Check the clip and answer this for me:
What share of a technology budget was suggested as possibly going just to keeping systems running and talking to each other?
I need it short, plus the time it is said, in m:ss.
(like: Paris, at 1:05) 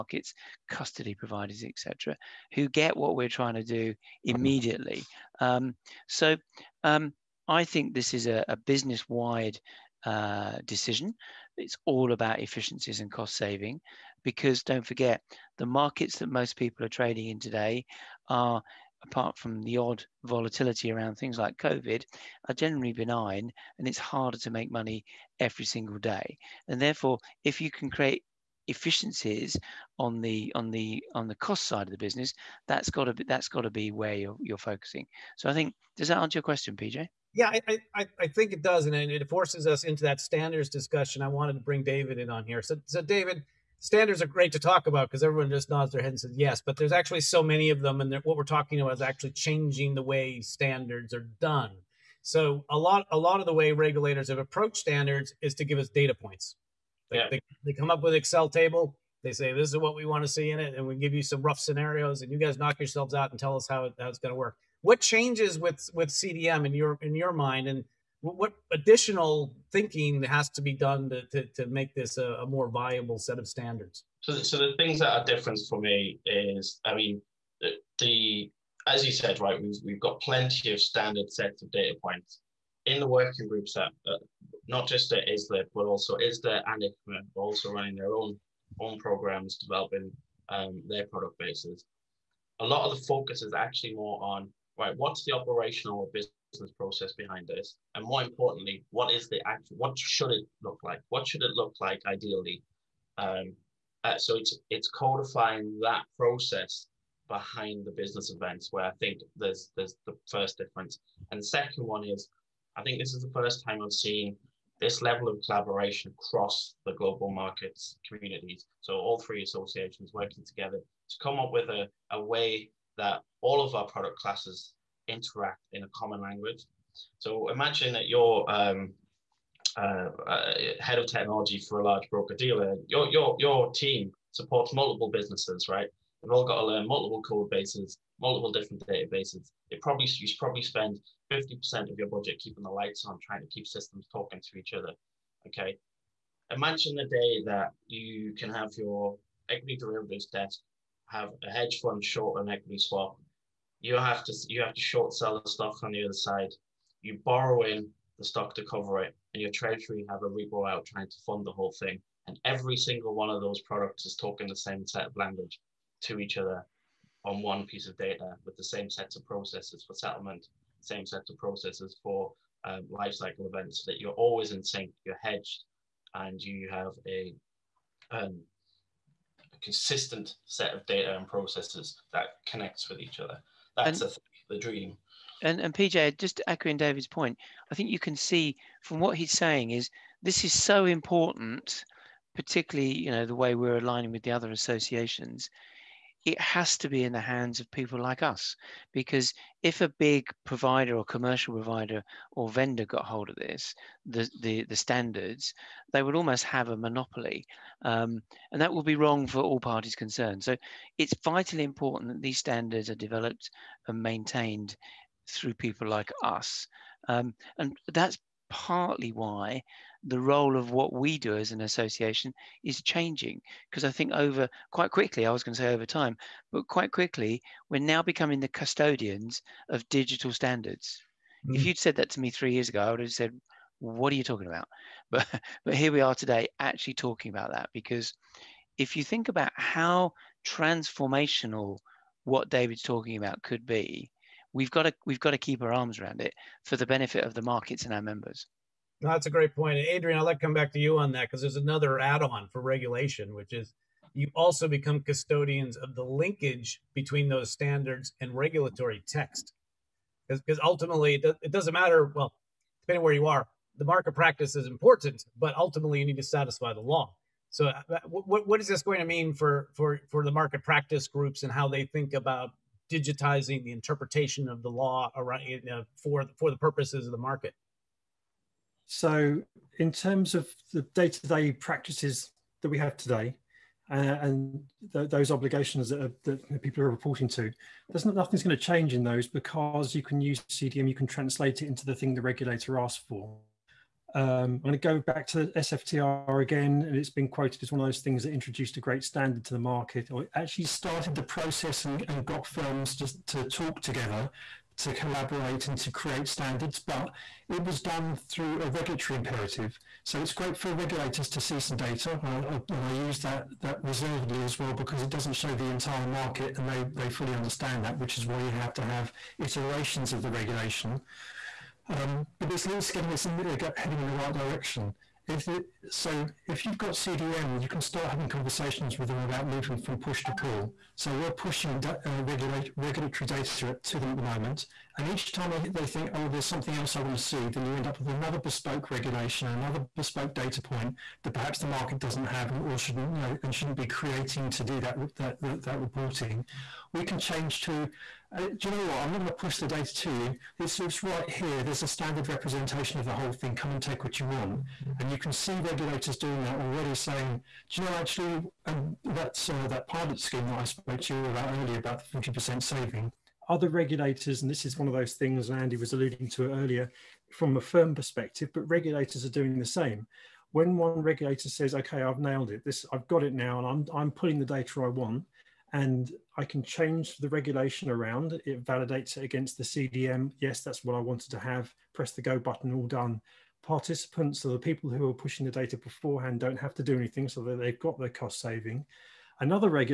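50%, at 2:21.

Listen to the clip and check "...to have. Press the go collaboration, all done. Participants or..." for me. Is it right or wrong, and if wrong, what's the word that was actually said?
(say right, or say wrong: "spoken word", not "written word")
wrong: "button", not "collaboration".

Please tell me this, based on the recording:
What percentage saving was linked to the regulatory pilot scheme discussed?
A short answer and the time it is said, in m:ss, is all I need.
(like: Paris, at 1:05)
40%, at 6:02.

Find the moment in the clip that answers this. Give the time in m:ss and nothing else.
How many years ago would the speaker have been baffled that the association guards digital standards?
3:52.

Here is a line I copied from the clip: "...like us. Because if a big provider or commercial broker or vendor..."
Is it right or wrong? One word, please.
wrong.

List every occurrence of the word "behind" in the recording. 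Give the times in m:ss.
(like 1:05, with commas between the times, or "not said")
1:37, 1:47.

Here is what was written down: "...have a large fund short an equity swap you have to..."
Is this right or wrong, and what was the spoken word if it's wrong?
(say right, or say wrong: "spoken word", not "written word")
wrong: "hedge", not "large".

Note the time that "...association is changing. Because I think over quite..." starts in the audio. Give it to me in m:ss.
3:41.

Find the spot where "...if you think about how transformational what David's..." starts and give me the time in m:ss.
3:58.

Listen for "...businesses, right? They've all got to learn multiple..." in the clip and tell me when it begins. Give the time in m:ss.
2:15.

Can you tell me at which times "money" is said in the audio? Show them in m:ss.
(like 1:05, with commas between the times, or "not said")
0:24.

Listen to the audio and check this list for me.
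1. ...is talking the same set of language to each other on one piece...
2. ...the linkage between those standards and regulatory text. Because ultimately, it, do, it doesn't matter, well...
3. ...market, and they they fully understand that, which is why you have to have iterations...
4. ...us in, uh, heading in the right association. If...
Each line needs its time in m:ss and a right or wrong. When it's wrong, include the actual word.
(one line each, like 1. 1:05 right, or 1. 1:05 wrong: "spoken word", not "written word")
1. 2:44 right
2. 4:15 right
3. 5:16 right
4. 5:23 wrong: "direction", not "association".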